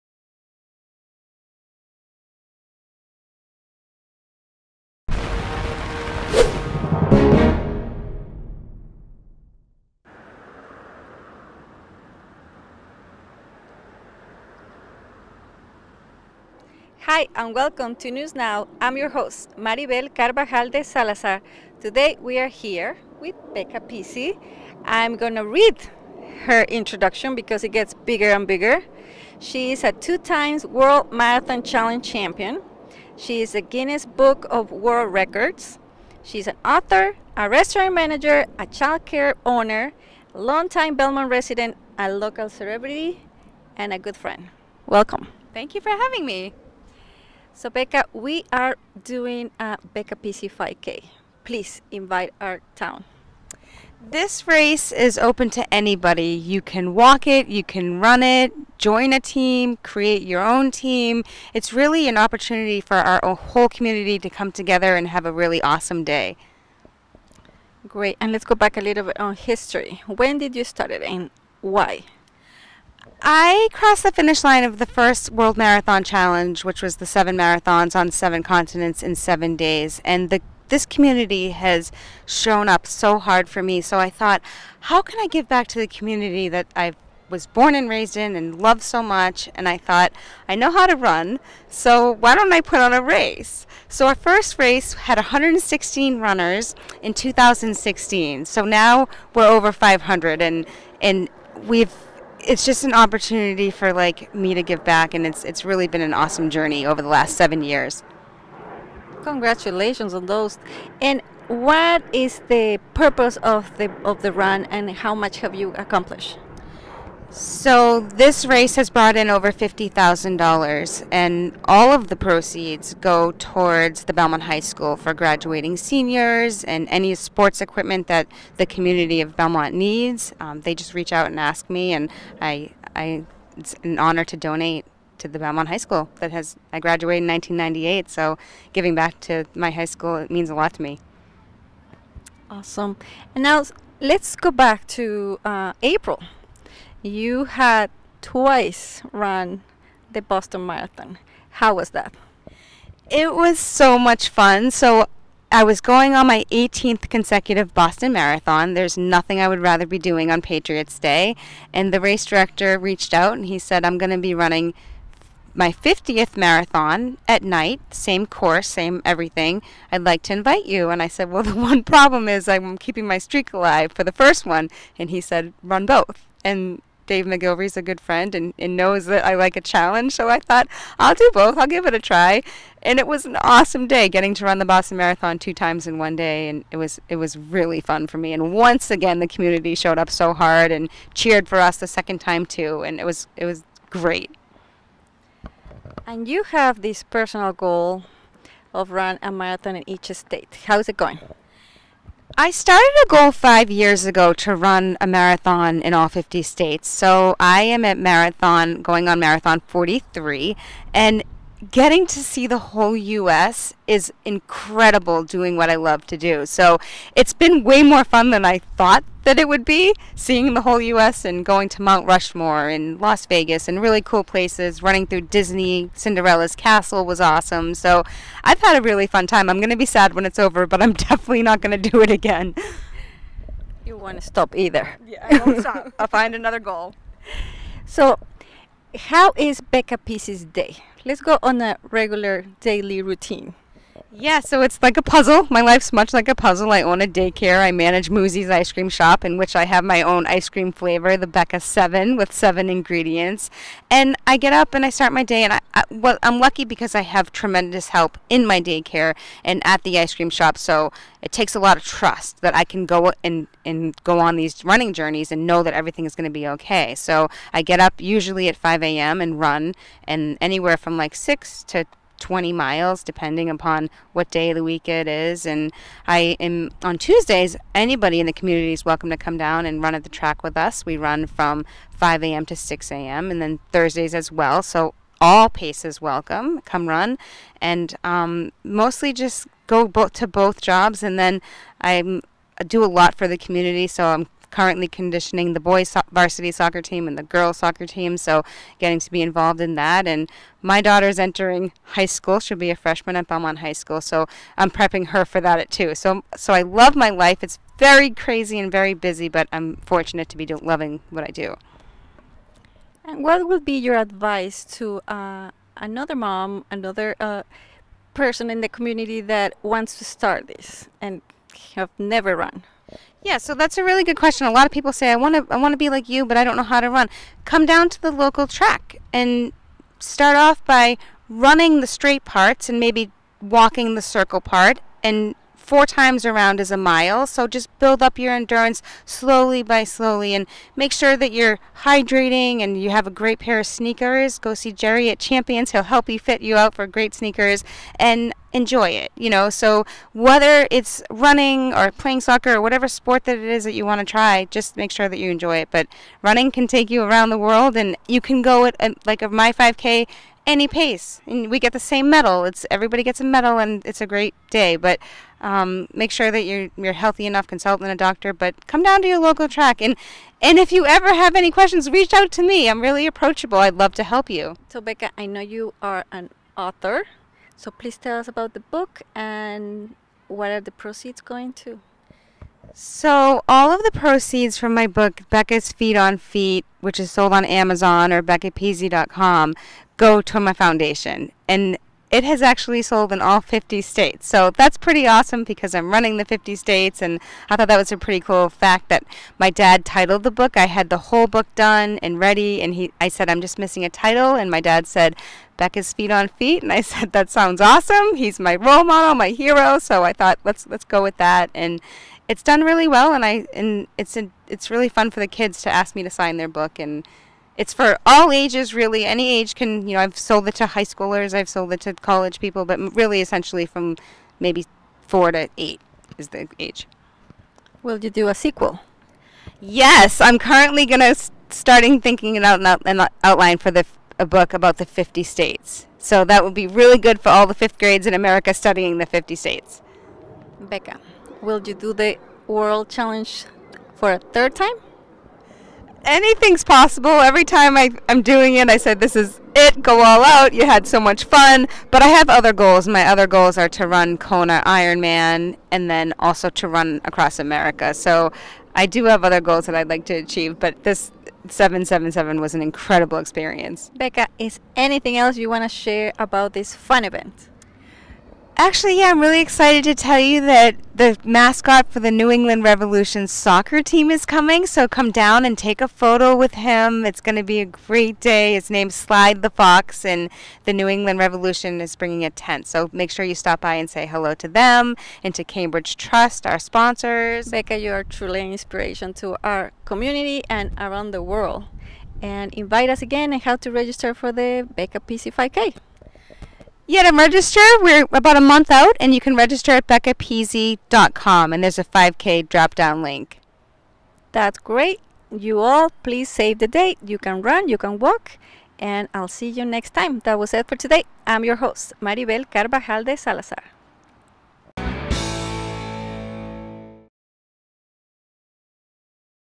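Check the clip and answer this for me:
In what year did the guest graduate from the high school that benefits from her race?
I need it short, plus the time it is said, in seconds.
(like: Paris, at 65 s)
1998, at 137 s.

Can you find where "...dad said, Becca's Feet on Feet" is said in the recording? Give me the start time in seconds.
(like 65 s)
404 s.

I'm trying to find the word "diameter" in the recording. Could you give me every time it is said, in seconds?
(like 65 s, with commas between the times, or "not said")
not said.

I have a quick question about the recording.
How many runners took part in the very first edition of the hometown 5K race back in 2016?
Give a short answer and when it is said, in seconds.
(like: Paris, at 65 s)
116, at 95 s.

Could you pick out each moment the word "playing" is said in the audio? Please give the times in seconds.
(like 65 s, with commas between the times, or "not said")
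351 s.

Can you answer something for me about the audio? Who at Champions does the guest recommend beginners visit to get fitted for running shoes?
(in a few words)
Jerry.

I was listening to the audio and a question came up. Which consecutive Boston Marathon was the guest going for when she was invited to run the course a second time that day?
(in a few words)
18th.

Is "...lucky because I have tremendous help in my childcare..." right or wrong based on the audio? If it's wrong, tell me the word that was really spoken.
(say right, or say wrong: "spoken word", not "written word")
wrong: "daycare", not "childcare".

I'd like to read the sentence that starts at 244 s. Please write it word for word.
Yeah, so it's like a puzzle.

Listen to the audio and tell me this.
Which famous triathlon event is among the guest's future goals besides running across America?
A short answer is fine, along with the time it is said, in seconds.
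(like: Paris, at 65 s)
Kona Ironman, at 454 s.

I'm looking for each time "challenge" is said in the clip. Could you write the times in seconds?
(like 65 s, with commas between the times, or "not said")
31 s, 76 s, 179 s, 442 s.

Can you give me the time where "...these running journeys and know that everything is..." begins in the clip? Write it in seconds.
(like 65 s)
264 s.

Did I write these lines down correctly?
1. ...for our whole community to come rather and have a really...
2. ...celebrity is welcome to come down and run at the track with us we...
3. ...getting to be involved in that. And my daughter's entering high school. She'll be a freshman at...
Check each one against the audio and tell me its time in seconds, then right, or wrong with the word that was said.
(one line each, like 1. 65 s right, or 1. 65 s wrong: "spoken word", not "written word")
1. 62 s wrong: "together", not "rather"
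2. 278 s wrong: "community", not "celebrity"
3. 298 s right.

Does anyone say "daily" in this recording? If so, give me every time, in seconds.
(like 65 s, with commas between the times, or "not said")
242 s.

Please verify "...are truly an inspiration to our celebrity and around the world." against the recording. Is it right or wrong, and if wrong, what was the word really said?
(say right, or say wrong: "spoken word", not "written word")
wrong: "community", not "celebrity".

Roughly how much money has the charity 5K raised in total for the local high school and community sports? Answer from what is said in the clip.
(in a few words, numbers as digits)
$50,000.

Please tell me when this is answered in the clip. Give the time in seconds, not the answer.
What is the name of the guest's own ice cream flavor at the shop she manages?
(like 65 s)
251 s.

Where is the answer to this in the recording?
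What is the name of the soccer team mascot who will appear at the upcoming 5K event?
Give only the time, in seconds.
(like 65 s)
479 s.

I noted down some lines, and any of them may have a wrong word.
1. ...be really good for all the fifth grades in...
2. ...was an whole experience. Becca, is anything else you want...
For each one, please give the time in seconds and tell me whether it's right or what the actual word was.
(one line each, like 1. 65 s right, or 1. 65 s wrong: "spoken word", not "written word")
1. 436 s right
2. 462 s wrong: "incredible", not "whole".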